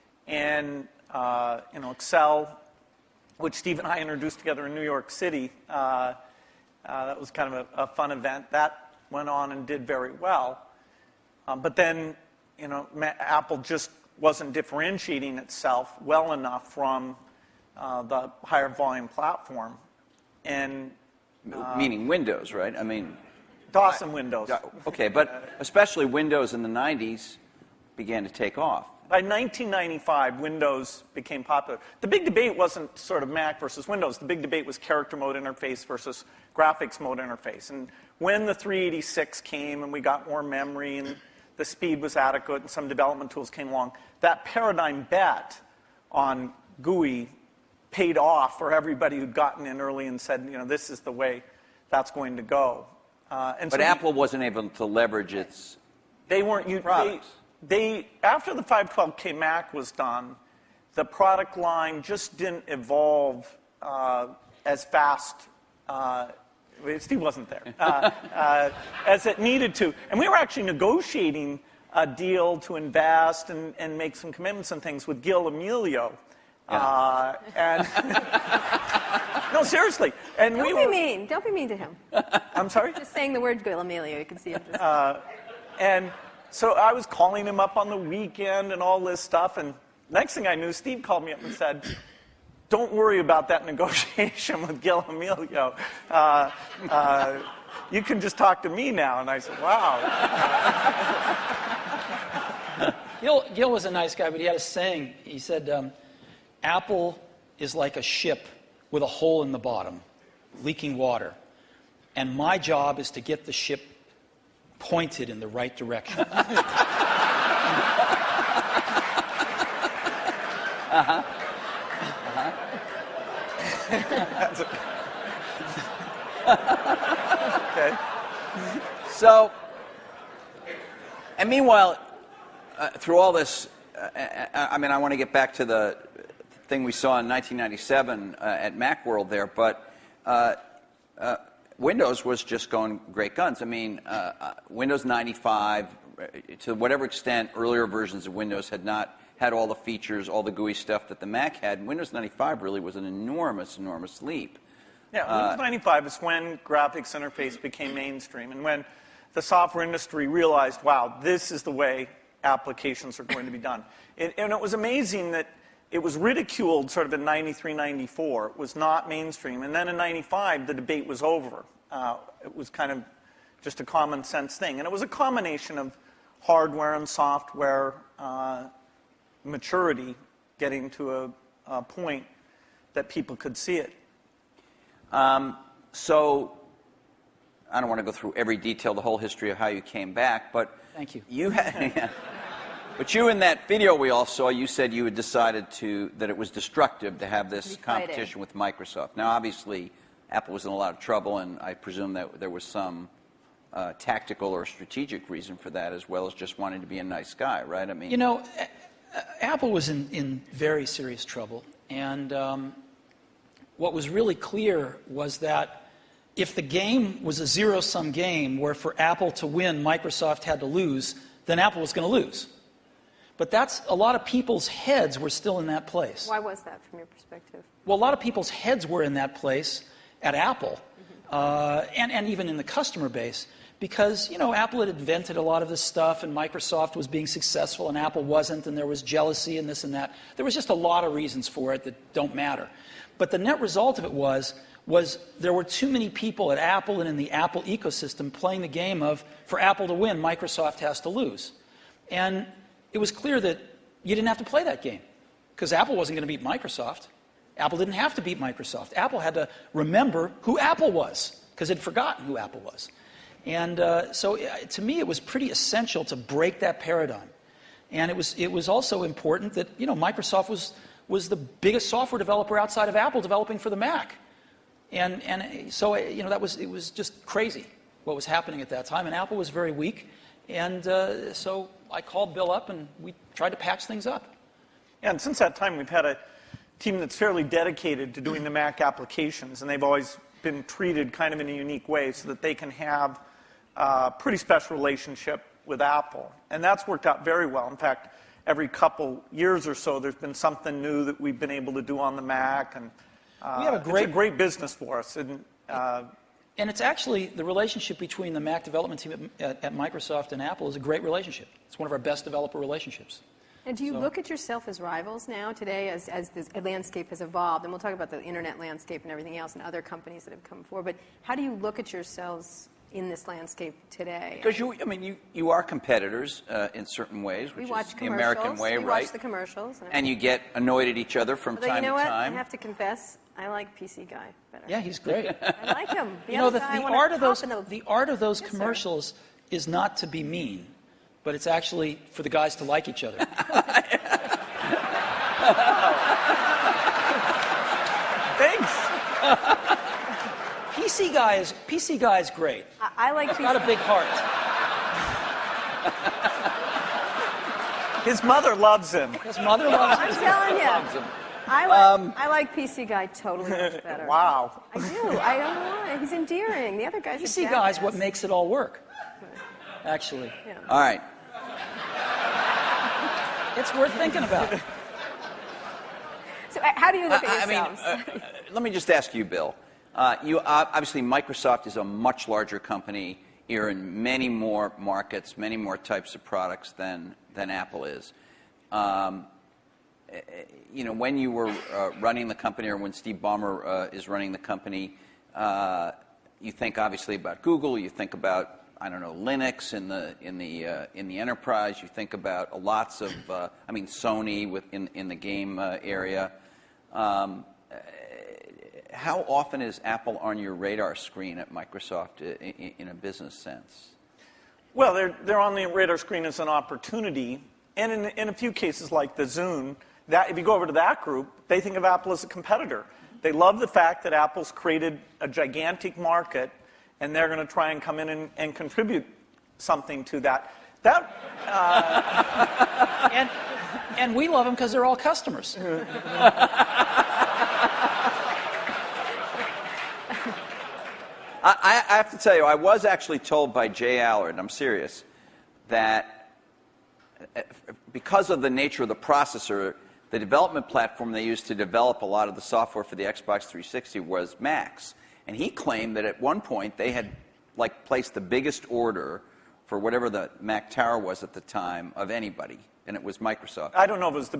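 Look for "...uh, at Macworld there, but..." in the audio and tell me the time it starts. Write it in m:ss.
2:18.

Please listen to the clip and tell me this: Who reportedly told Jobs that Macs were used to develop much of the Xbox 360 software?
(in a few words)
J Allard.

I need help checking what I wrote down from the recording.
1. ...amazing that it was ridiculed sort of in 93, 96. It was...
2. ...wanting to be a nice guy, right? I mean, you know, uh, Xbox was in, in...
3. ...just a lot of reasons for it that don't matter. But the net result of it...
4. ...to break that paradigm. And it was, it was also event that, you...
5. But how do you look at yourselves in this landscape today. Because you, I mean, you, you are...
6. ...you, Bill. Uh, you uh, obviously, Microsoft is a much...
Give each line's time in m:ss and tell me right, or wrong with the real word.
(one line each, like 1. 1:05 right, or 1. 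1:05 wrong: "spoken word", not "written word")
1. 2:44 wrong: "94", not "96"
2. 3:26 wrong: "Apple", not "Xbox"
3. 4:00 right
4. 4:26 wrong: "important", not "event"
5. 5:20 right
6. 6:19 right.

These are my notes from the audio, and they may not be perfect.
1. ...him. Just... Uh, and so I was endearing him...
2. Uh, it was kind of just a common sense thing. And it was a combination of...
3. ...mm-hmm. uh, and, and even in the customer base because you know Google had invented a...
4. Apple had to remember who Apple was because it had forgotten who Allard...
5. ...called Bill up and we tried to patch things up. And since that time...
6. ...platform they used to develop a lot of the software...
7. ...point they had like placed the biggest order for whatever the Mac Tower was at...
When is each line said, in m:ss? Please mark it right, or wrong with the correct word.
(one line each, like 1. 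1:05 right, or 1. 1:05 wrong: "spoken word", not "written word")
1. 1:24 wrong: "calling", not "endearing"
2. 2:51 right
3. 3:50 wrong: "Apple", not "Google"
4. 4:18 wrong: "Apple", not "Allard"
5. 4:42 right
6. 7:30 right
7. 7:36 right.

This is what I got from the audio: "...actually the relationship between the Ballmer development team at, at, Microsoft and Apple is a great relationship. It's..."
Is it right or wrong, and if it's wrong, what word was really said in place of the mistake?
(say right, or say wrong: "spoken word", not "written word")
wrong: "Mac", not "Ballmer".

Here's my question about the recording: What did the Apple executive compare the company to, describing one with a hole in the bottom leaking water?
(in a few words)
A ship.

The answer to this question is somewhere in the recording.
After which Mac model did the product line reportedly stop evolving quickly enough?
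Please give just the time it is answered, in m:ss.
0:58.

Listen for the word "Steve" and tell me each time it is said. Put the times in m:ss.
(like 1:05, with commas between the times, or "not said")
0:03, 1:06, 1:30, 6:32.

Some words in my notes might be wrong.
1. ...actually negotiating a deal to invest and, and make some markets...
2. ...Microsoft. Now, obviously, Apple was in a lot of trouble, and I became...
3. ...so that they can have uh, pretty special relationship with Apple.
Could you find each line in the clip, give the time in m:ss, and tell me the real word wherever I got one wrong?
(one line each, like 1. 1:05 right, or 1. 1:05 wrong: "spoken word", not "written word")
1. 1:10 wrong: "commitments", not "markets"
2. 3:18 wrong: "presume", not "became"
3. 4:52 right.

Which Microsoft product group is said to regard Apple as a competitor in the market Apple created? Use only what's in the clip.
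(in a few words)
Zune.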